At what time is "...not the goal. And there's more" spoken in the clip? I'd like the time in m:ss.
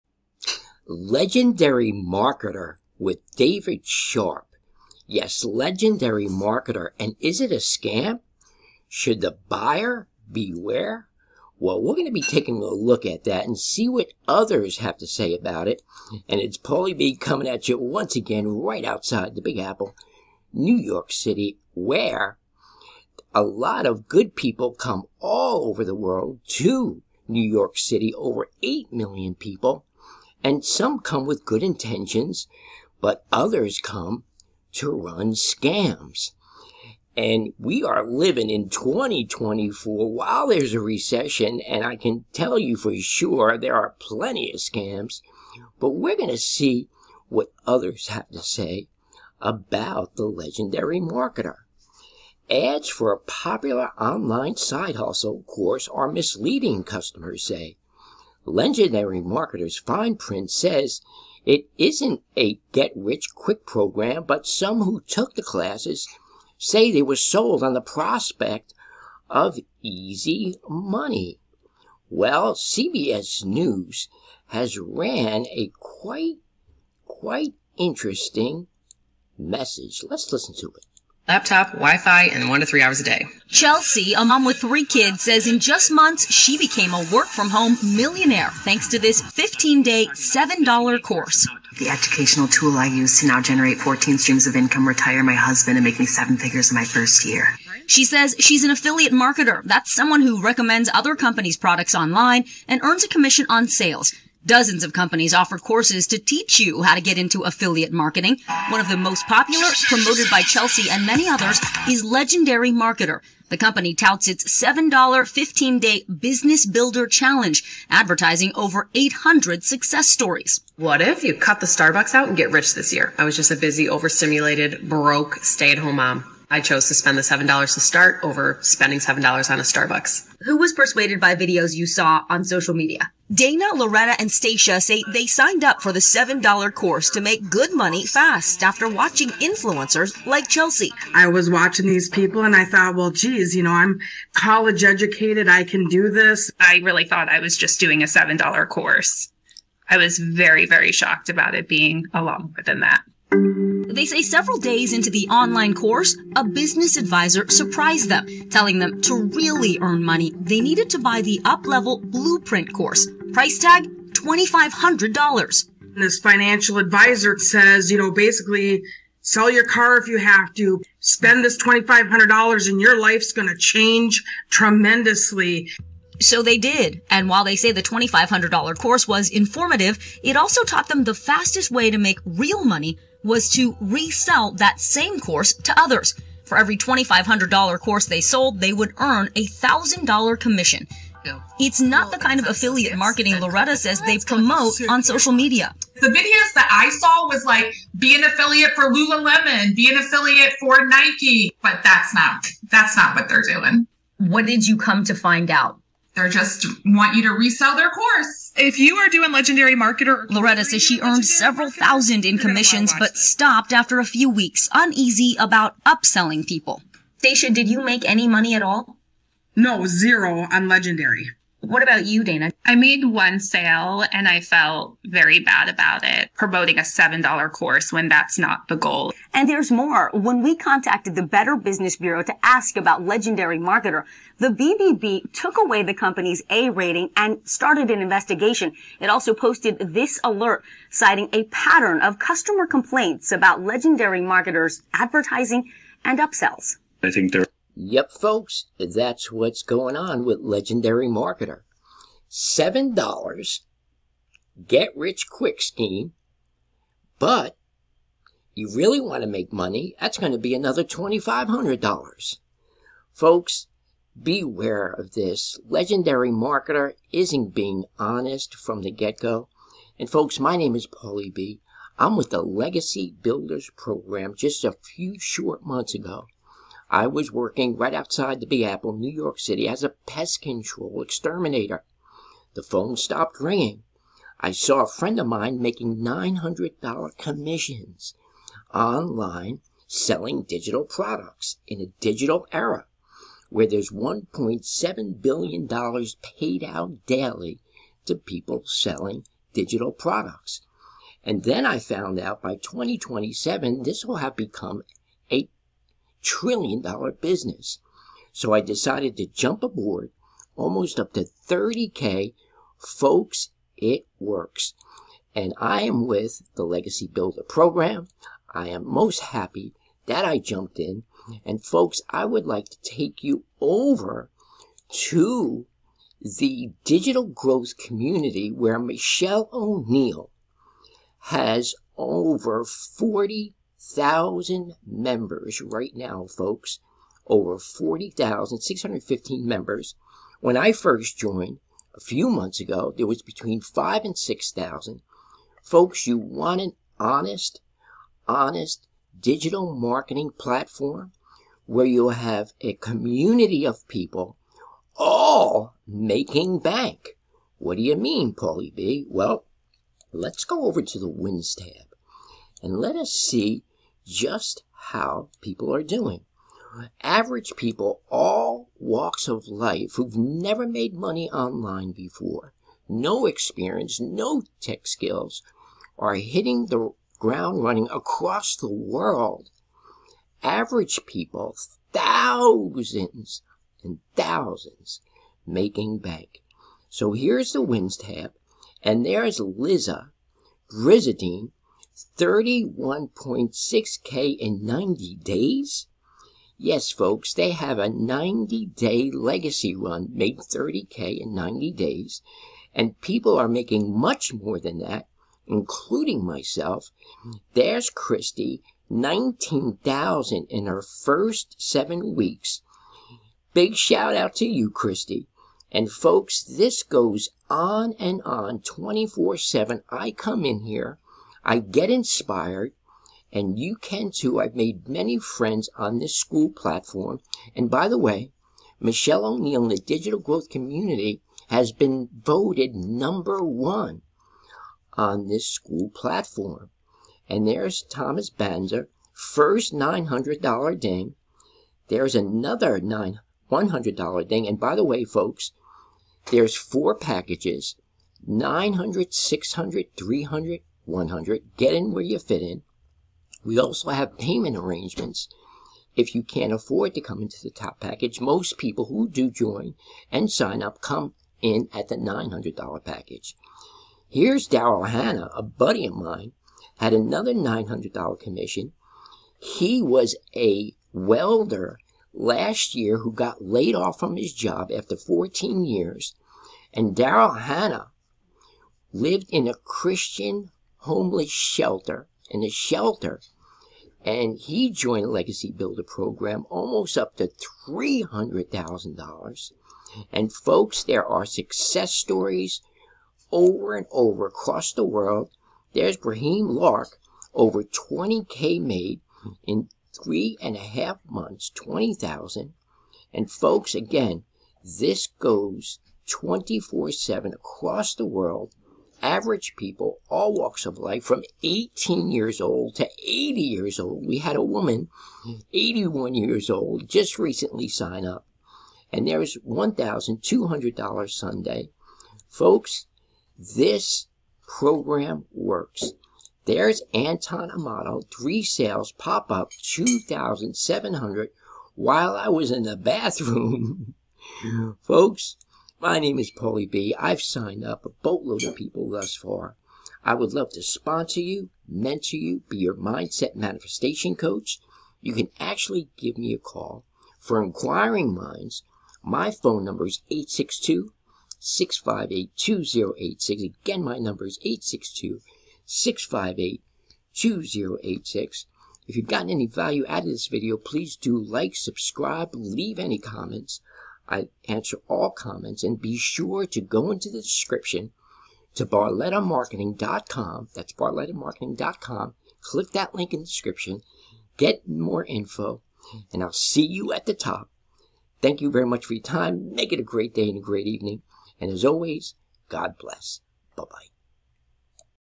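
3:48.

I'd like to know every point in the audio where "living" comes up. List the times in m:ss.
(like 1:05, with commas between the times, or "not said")
0:38.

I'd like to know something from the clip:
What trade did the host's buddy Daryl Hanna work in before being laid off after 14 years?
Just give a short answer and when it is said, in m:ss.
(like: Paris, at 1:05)
welder, at 7:50.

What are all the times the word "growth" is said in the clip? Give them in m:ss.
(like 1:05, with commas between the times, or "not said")
5:27, 7:10.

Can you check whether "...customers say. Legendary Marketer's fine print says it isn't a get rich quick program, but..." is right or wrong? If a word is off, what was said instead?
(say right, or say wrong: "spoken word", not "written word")
right.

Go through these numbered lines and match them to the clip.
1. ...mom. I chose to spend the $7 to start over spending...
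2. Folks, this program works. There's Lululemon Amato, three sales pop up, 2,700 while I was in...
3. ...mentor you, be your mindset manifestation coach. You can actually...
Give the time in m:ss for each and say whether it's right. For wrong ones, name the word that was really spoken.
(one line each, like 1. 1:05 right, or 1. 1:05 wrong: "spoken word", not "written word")
1. 2:05 right
2. 8:42 wrong: "Anton", not "Lululemon"
3. 9:01 right.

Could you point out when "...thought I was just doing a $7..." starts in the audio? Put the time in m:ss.
2:27.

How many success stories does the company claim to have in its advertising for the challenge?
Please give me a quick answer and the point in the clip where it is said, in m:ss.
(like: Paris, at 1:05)
over 800, at 1:58.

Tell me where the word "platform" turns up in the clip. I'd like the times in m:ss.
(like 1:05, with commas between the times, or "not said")
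5:50, 7:06, 7:15.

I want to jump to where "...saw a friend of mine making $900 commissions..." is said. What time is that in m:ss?
4:44.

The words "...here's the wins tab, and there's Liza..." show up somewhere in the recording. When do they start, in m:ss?
6:27.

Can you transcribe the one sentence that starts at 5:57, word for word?
What do you mean, Paulie B?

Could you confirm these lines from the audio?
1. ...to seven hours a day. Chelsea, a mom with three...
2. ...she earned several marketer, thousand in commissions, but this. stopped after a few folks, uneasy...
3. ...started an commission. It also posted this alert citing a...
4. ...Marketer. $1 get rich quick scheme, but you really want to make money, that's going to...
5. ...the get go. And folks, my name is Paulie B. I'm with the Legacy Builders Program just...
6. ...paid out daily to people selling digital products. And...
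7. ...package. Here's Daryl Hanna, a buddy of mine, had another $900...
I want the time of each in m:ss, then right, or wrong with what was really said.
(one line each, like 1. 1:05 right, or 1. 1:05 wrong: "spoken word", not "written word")
1. 1:22 wrong: "three", not "seven"
2. 3:30 wrong: "weeks", not "folks"
3. 3:57 wrong: "investigation", not "commission"
4. 4:11 wrong: "7", not "1"
5. 4:28 right
6. 4:56 right
7. 7:42 right.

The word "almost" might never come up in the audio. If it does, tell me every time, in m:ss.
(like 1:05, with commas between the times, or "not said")
5:10, 8:06.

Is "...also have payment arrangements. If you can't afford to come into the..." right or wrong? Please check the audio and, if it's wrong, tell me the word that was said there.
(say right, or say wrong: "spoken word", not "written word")
right.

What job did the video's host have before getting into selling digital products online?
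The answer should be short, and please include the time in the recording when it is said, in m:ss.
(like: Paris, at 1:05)
pest control exterminator, at 4:40.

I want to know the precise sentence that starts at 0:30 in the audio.
And some come with good intentions, but others come to run scams.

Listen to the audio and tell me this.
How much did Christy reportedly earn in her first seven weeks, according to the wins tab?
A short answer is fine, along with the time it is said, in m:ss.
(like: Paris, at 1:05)
19,000, at 6:48.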